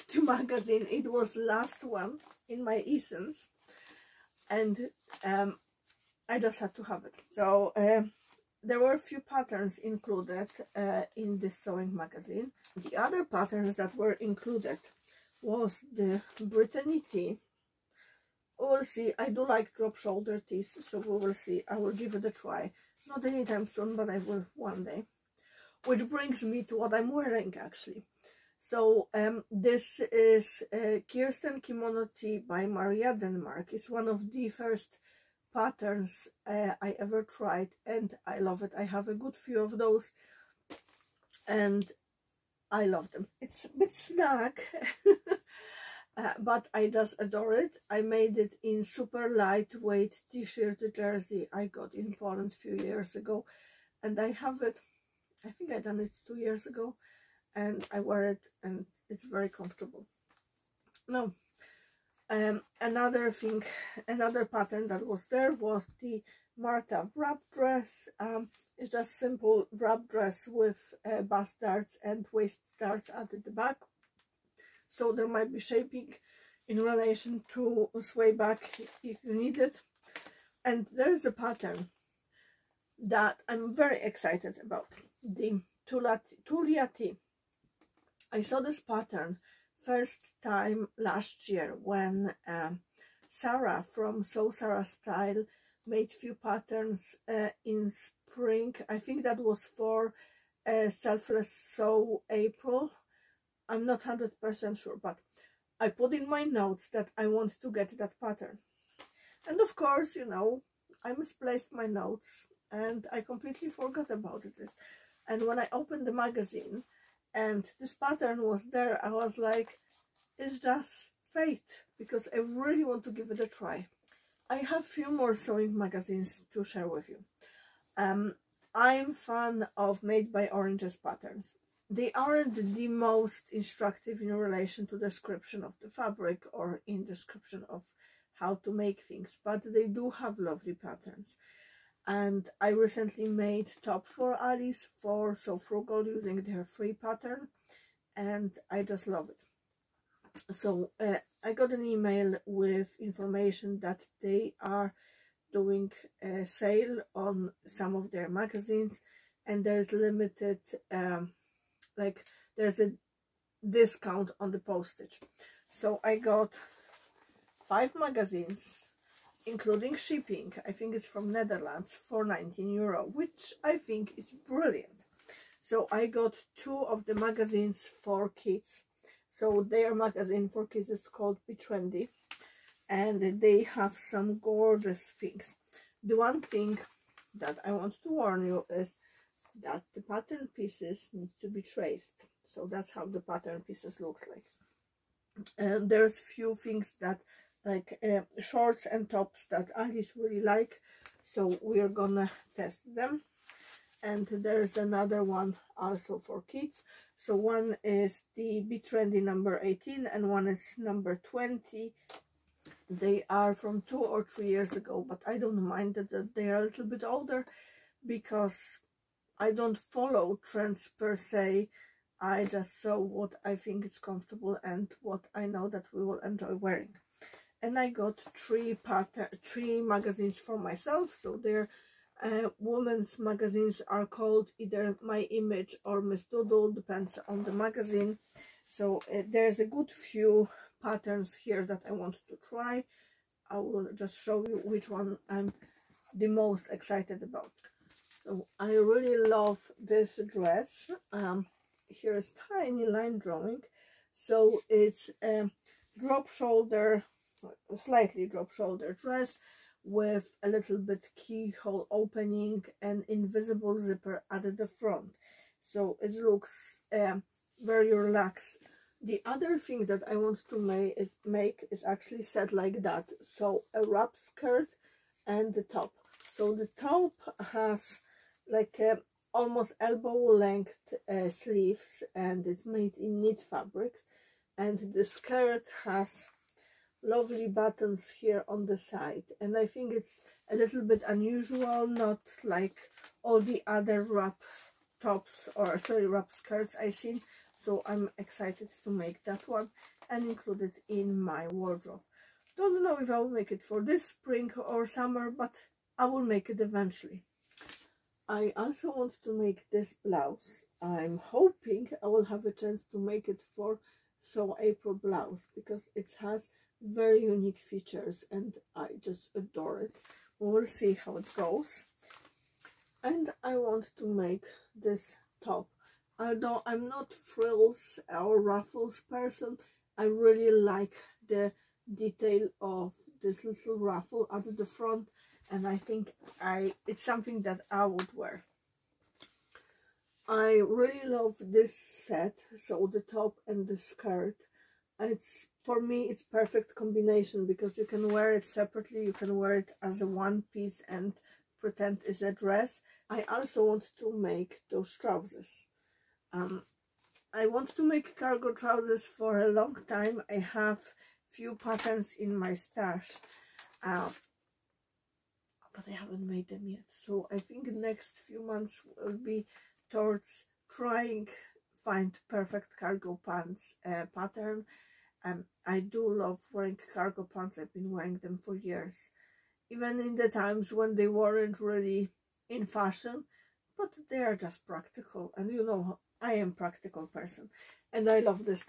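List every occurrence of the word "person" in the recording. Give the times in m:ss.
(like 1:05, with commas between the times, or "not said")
5:29, 6:27.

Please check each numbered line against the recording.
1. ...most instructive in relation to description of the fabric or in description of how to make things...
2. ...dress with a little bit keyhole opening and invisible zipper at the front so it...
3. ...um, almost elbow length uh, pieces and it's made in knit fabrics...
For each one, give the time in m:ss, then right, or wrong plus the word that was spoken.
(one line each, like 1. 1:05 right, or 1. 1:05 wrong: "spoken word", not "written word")
1. 2:12 right
2. 4:18 right
3. 4:38 wrong: "sleeves", not "pieces".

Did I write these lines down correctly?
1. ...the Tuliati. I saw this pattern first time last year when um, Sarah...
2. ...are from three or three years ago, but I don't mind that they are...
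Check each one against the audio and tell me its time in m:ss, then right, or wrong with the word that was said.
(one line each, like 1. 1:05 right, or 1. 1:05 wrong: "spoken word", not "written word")
1. 1:25 right
2. 3:33 wrong: "two", not "three".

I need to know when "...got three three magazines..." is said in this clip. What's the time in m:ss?
3:47.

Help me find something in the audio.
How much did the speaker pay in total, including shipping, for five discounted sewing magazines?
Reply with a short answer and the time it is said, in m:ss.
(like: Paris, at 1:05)
19 euro, at 2:52.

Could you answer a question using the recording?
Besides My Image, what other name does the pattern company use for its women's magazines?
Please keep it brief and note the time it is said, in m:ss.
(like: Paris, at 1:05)
Miss Doodle, at 3:56.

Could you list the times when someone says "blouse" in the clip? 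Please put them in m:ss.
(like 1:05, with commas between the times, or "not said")
5:10, 5:14.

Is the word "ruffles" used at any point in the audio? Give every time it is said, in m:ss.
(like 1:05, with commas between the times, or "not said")
5:28, 5:33.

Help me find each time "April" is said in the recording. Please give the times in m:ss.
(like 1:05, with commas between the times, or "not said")
1:42, 5:14.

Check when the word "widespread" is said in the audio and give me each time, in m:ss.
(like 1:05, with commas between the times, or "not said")
not said.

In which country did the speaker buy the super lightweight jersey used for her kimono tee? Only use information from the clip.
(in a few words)
Poland.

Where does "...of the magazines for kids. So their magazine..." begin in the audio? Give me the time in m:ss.
2:56.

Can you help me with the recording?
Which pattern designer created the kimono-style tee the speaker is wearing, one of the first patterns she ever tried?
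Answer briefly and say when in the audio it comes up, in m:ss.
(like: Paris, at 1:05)
Maria Denmark, at 0:32.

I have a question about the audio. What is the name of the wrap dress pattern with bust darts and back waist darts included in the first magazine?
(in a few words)
Marta.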